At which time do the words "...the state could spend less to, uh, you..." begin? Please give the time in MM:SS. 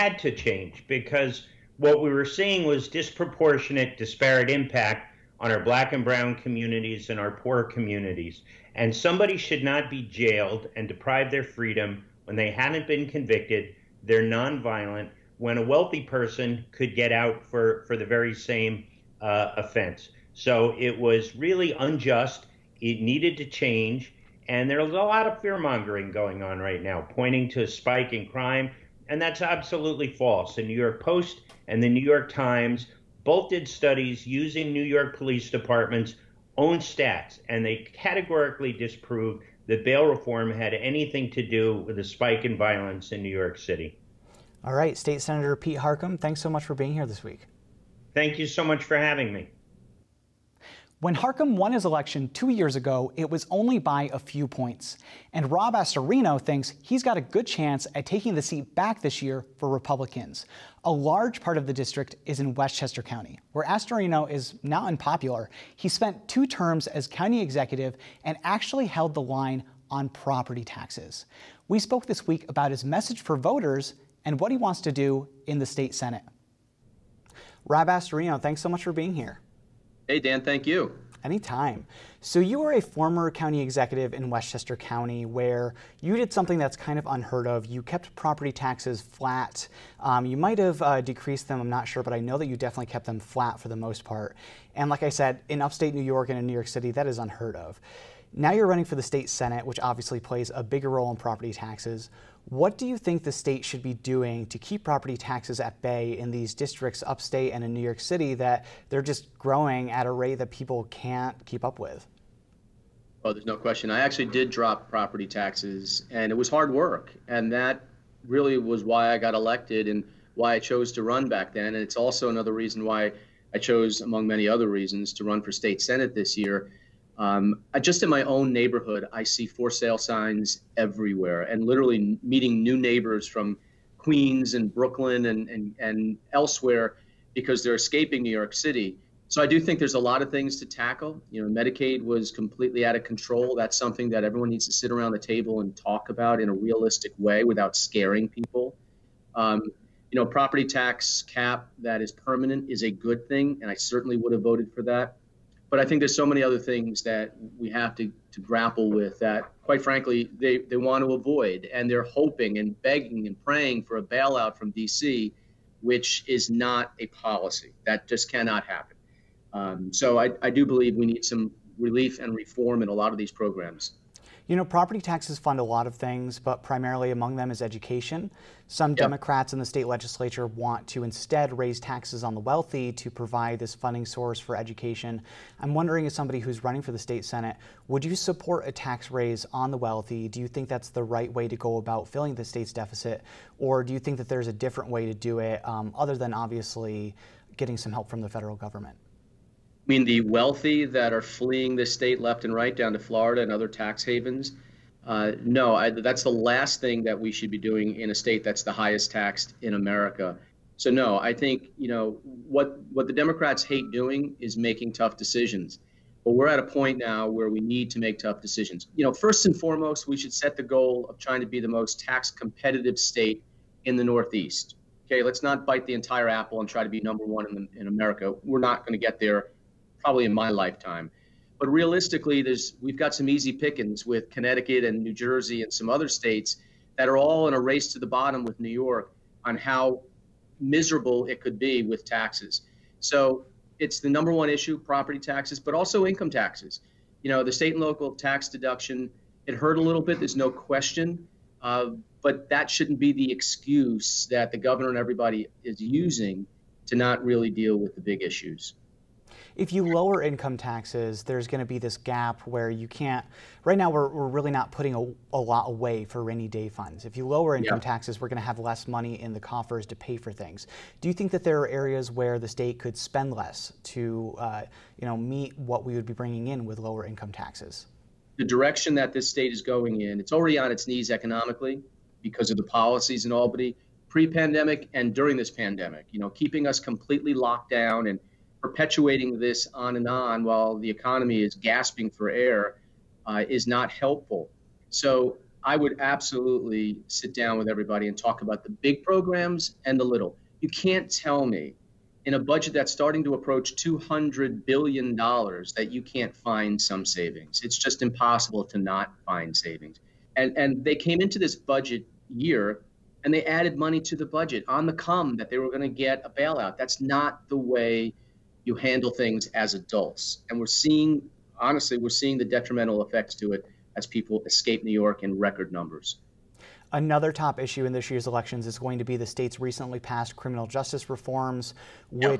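04:32.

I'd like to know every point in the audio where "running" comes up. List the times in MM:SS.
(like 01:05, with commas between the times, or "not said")
01:38, 03:06.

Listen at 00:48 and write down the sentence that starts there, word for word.
Thank you so much for having me.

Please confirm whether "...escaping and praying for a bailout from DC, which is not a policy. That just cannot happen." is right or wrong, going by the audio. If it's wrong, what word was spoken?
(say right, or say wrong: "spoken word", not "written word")
wrong: "begging", not "escaping".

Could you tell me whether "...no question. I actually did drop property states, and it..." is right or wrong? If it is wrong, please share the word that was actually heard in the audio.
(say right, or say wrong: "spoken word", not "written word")
wrong: "taxes", not "states".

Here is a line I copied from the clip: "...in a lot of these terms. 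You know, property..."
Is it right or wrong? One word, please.
wrong.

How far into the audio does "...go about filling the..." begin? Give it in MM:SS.
03:11.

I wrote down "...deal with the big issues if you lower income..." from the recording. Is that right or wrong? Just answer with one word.
right.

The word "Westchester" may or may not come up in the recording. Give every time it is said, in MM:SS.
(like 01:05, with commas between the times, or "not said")
01:02, 01:24.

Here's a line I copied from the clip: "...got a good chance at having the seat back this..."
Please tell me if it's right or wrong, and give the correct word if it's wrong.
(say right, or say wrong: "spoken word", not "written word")
wrong: "taking", not "having".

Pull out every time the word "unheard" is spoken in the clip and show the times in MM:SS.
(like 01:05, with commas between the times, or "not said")
01:27, 01:37.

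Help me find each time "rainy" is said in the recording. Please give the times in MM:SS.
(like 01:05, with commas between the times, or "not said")
04:26.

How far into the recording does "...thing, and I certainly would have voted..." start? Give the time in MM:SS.
02:33.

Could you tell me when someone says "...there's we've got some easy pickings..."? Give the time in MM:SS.
03:52.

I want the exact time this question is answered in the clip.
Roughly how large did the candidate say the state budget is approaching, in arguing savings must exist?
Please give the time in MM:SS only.
05:03.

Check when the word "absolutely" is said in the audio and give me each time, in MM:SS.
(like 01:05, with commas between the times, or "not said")
00:29, 04:56.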